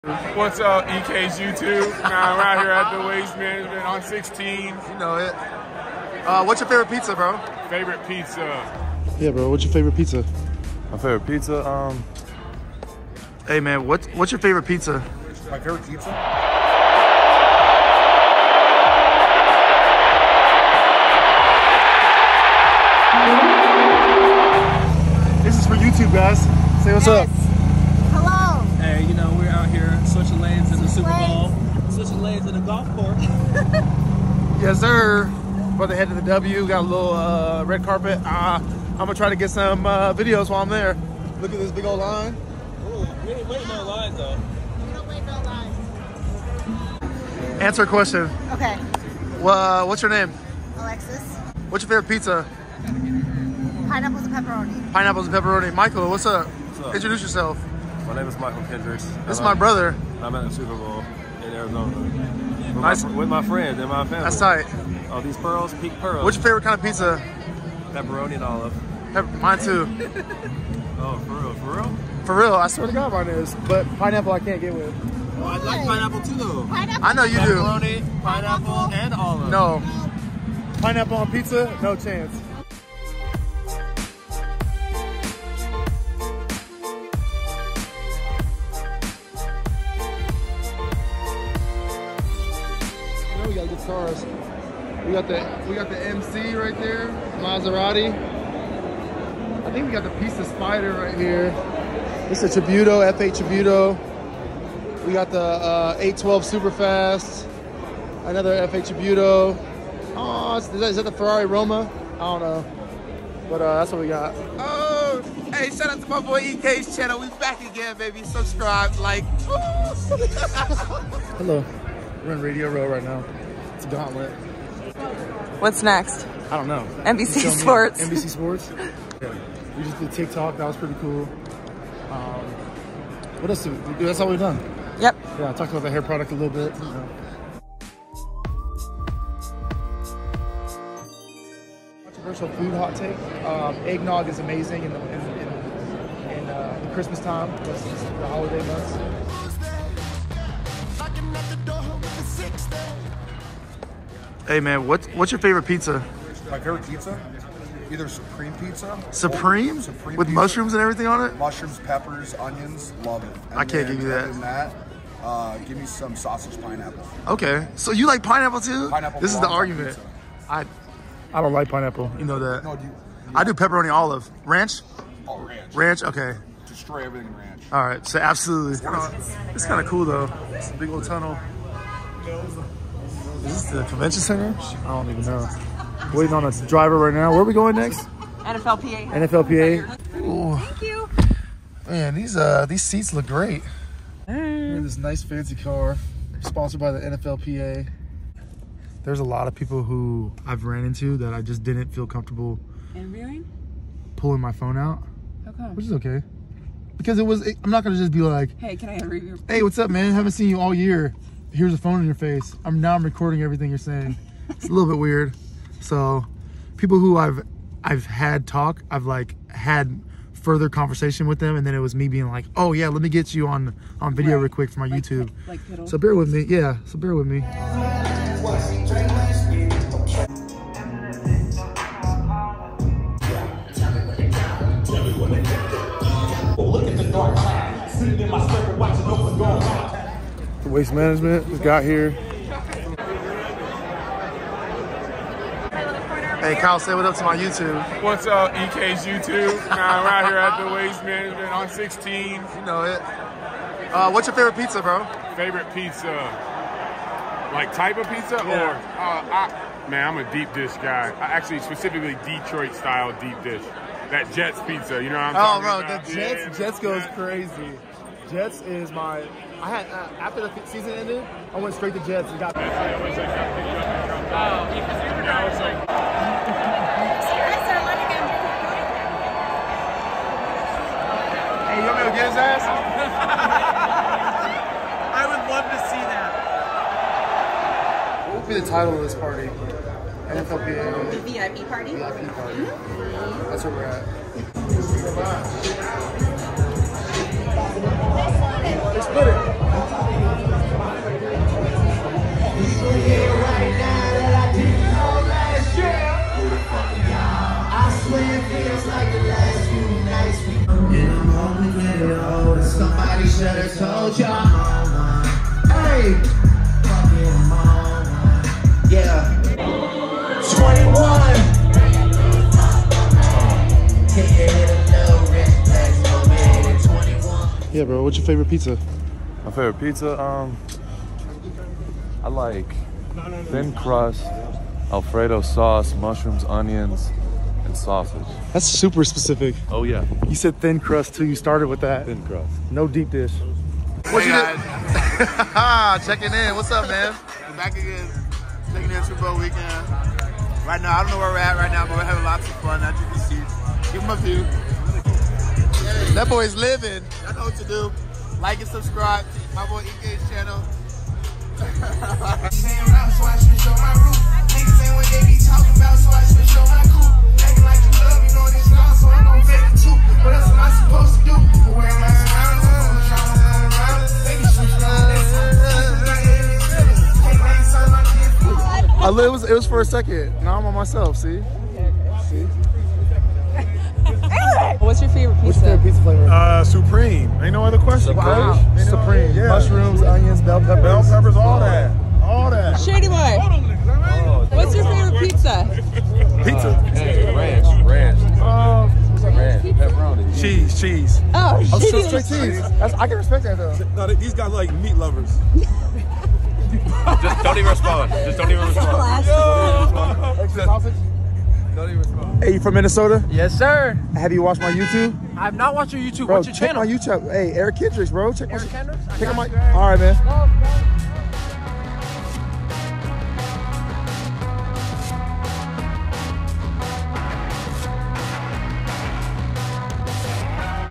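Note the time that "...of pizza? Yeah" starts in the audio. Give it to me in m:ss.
4:17.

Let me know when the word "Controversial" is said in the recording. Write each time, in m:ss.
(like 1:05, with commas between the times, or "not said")
2:22.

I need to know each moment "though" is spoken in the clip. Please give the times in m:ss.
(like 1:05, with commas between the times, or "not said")
0:44, 1:16, 3:00, 6:43.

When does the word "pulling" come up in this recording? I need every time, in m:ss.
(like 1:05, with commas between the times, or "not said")
3:24.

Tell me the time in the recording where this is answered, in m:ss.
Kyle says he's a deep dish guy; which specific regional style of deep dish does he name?
4:22.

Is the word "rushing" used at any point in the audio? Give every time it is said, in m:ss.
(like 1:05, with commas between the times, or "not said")
not said.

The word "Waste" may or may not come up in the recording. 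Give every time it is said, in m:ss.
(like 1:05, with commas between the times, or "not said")
0:03, 4:00, 4:10.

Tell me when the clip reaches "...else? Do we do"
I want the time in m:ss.
2:13.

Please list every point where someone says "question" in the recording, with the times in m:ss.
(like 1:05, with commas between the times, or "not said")
0:47, 6:27.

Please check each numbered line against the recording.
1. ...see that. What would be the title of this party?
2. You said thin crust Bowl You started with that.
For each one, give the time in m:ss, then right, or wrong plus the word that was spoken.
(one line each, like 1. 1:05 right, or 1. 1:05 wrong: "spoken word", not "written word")
1. 4:45 right
2. 5:40 wrong: "Till", not "Bowl".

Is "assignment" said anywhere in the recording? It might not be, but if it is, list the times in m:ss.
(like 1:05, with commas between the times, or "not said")
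not said.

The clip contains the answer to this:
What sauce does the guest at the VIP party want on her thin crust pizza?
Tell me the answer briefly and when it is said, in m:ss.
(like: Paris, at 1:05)
Alfredo sauce, at 5:34.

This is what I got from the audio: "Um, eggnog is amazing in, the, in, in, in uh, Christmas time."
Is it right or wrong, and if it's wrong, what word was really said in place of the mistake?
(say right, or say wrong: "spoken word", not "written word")
right.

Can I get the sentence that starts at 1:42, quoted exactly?
This is a Tributo, F8 Tributo.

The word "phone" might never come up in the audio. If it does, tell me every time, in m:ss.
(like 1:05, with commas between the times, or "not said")
3:24, 3:31.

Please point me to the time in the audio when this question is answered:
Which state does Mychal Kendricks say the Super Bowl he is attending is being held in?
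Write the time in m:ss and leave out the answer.
1:01.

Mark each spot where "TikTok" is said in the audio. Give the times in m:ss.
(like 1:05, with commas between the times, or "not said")
2:10.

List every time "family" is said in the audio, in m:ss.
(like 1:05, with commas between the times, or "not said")
1:04.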